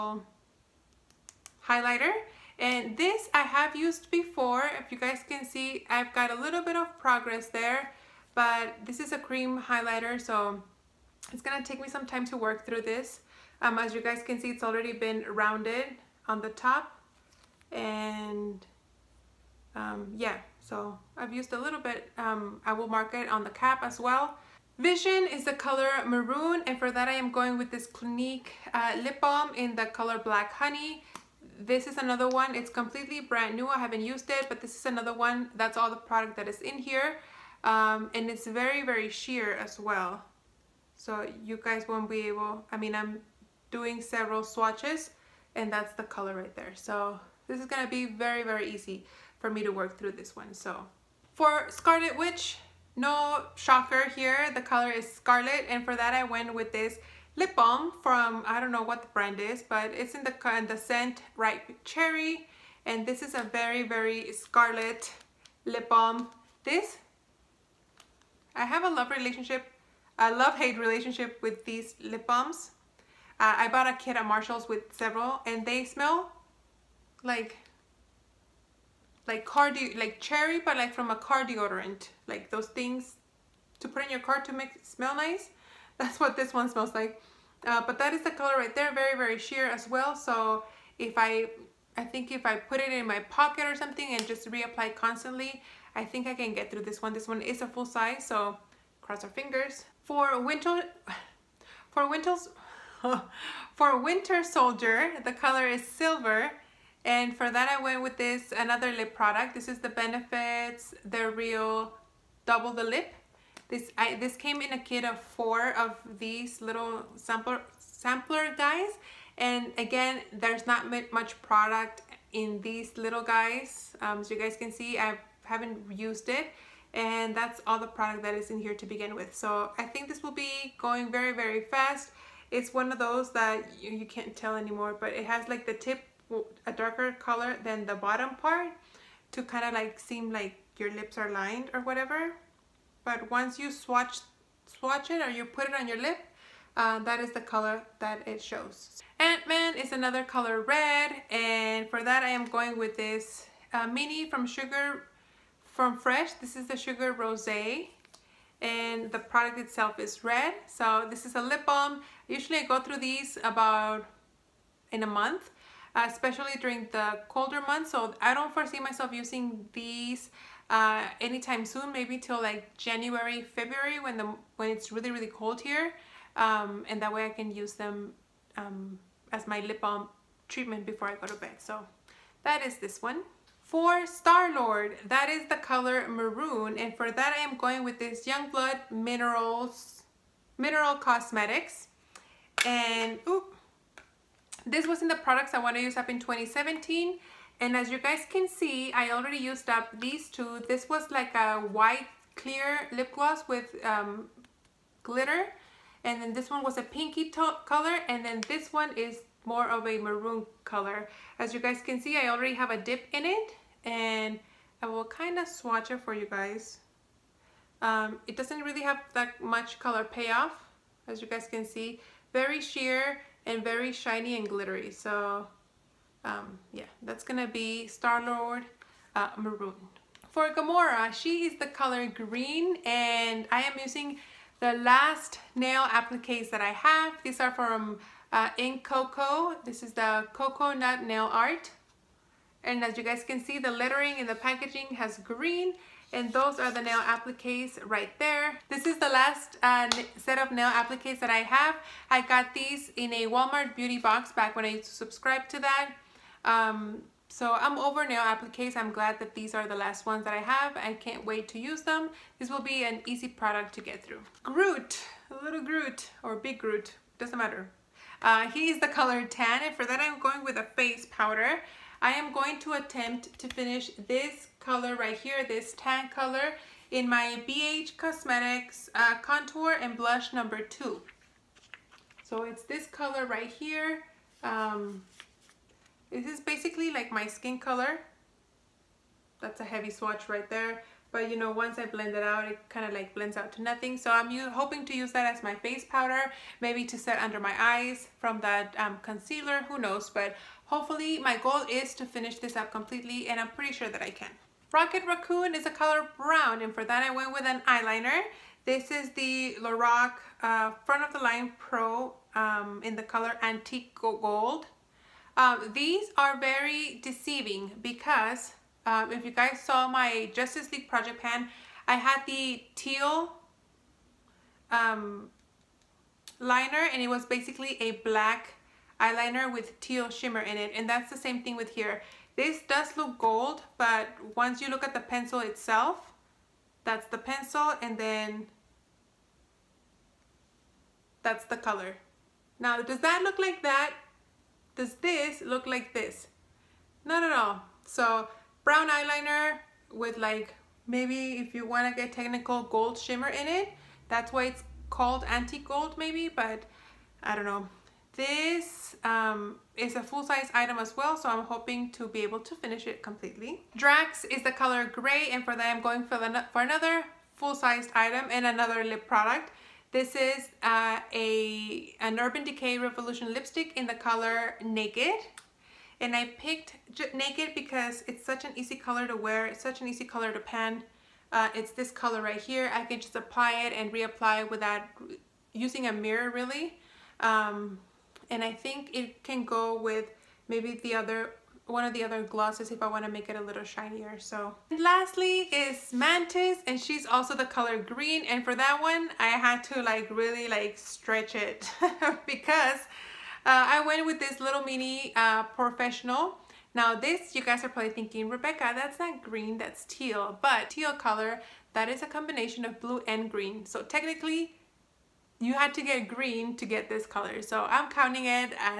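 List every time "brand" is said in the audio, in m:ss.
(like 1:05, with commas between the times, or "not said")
0:33, 0:59.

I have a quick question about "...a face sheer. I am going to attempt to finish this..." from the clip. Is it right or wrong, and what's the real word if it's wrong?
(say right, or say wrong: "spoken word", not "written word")
wrong: "powder", not "sheer".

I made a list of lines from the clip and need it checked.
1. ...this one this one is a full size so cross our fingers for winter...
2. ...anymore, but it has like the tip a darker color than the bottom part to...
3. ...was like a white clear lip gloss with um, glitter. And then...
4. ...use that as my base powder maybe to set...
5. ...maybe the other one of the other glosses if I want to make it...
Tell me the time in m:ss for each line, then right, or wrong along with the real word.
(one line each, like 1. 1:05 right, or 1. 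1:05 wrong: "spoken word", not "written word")
1. 1:36 right
2. 2:14 right
3. 3:20 right
4. 4:54 right
5. 6:30 right.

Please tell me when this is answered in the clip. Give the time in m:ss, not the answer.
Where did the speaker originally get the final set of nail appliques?
4:13.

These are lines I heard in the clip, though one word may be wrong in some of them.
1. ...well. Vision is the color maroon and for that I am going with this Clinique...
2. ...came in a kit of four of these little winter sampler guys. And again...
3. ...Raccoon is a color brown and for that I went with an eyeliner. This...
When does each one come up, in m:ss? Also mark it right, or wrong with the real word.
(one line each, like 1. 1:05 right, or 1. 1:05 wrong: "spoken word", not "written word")
1. 0:23 right
2. 1:54 wrong: "sampler", not "winter"
3. 5:05 right.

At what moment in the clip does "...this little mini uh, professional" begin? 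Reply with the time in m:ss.
6:44.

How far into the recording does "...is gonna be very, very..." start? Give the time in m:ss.
0:47.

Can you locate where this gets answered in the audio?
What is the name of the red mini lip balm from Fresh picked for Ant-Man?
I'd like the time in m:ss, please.
2:36.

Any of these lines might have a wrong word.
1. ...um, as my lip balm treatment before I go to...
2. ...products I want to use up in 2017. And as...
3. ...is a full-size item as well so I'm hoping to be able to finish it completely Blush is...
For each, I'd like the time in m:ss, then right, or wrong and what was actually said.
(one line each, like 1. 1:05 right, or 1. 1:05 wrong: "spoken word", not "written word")
1. 2:58 right
2. 3:15 right
3. 5:59 wrong: "Drax", not "Blush".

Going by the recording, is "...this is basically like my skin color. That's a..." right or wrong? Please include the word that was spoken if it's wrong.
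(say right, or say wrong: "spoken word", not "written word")
right.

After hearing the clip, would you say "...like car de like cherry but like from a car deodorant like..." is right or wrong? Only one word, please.
right.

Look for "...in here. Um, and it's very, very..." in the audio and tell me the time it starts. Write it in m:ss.
0:36.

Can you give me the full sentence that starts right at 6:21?
Uh, it's this color right here.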